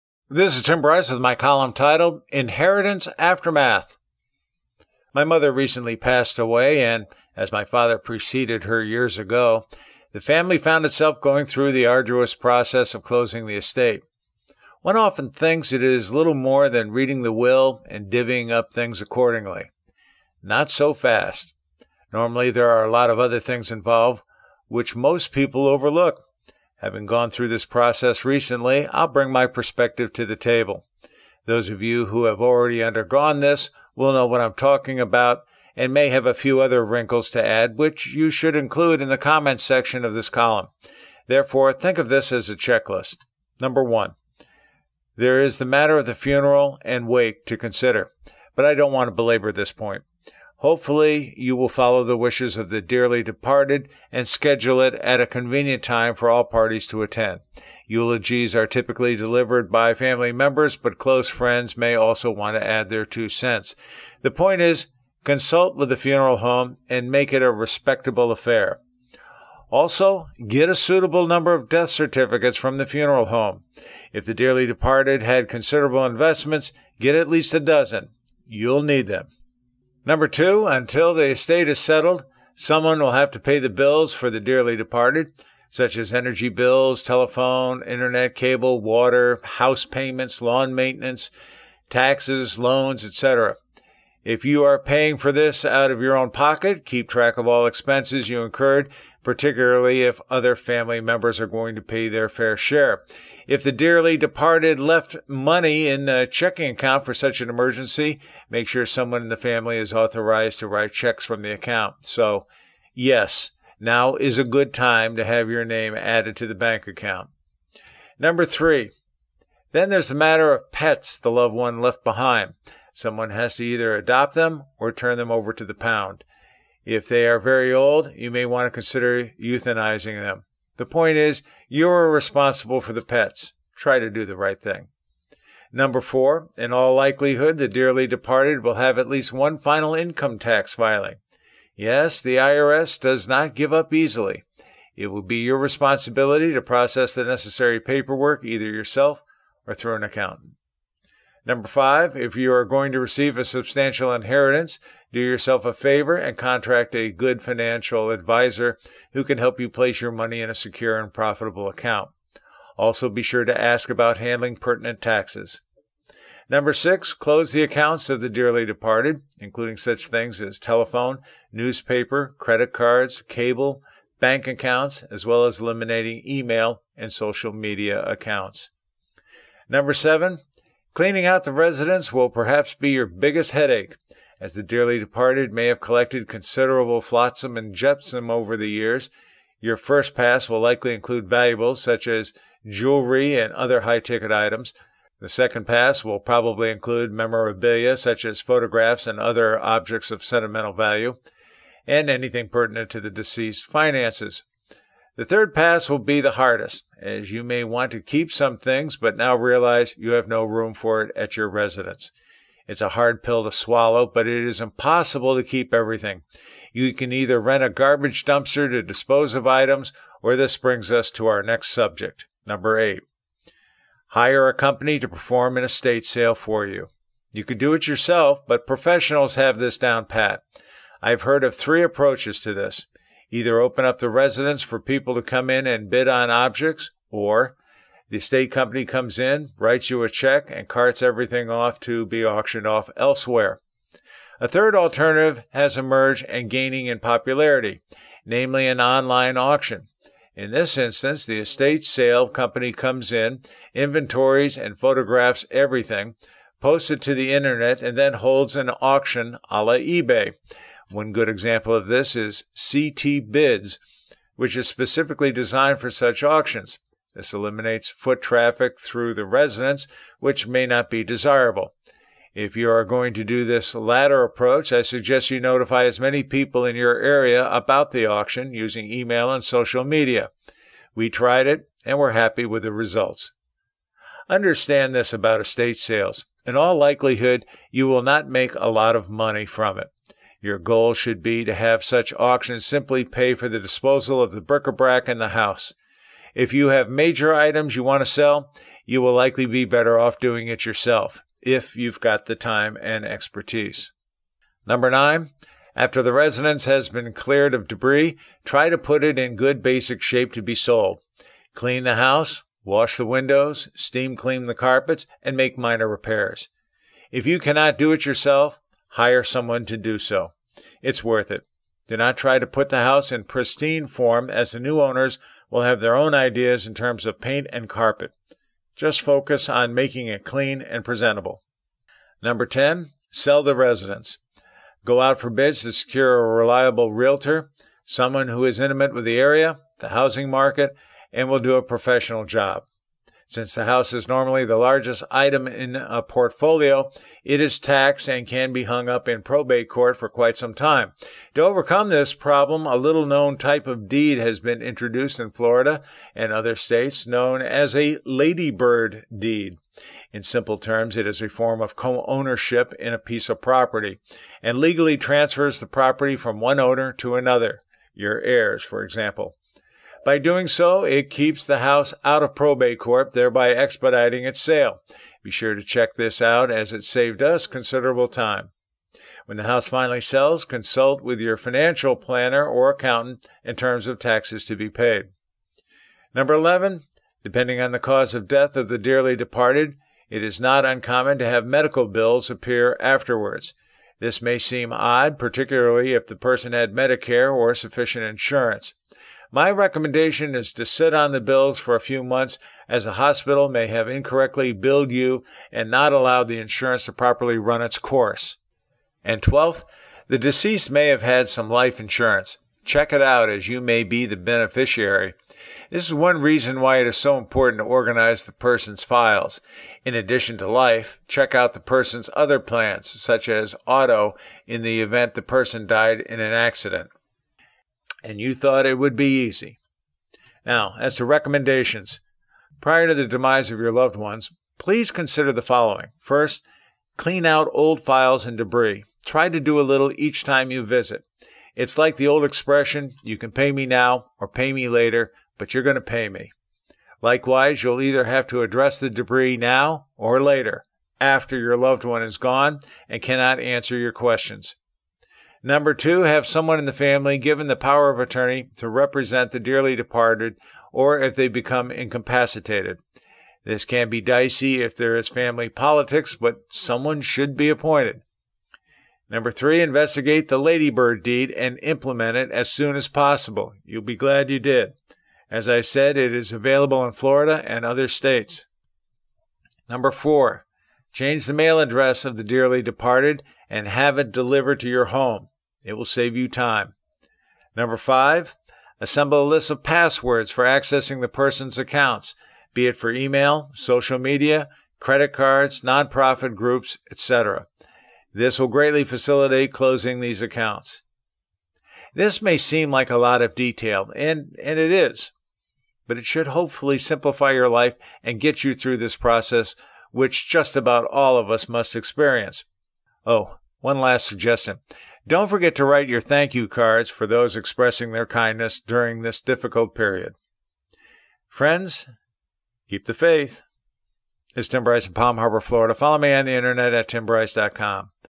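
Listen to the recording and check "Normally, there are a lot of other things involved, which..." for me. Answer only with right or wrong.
right.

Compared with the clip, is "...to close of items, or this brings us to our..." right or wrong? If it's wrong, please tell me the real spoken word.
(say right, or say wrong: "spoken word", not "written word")
wrong: "dispose", not "close".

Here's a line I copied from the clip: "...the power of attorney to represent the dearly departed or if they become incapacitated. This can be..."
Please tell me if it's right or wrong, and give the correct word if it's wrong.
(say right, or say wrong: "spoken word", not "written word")
right.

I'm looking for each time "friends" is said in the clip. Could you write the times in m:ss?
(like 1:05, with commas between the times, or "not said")
1:01, 8:41.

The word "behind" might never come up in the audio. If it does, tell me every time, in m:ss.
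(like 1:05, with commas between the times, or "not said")
2:02.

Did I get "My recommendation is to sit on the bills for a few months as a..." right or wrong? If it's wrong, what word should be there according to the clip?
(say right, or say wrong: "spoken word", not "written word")
right.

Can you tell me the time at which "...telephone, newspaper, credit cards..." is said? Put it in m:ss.
2:50.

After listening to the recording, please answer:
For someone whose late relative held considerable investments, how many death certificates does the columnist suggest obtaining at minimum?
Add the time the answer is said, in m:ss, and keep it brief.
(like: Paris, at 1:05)
12, at 1:17.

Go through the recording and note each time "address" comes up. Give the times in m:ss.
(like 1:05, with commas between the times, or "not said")
7:28, 8:01.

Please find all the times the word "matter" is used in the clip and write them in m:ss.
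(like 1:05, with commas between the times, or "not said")
0:45, 2:00.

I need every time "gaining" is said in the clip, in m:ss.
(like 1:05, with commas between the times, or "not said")
4:06.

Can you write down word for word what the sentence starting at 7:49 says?
Number three, investigate the ladybird deed and implement it as soon as possible.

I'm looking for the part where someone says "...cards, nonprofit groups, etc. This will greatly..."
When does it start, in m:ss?
8:15.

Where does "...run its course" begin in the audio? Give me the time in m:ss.
6:47.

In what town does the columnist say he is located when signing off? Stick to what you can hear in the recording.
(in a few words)
Palm Harbor.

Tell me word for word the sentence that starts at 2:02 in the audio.
Someone has to either adopt them or turn them over to the pound.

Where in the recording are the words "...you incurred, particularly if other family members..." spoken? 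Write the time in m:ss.
1:38.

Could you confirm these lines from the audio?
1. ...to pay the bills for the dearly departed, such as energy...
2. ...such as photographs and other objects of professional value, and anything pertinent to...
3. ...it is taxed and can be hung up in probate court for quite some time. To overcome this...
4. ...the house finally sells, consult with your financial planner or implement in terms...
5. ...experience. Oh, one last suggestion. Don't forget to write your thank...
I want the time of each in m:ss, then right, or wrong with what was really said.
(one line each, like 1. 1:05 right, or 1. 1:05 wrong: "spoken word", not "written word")
1. 1:23 right
2. 3:17 wrong: "sentimental", not "professional"
3. 5:47 right
4. 6:19 wrong: "accountant", not "implement"
5. 8:31 right.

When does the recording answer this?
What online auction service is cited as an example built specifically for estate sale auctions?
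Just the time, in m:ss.
4:22.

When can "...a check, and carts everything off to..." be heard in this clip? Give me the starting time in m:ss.
4:00.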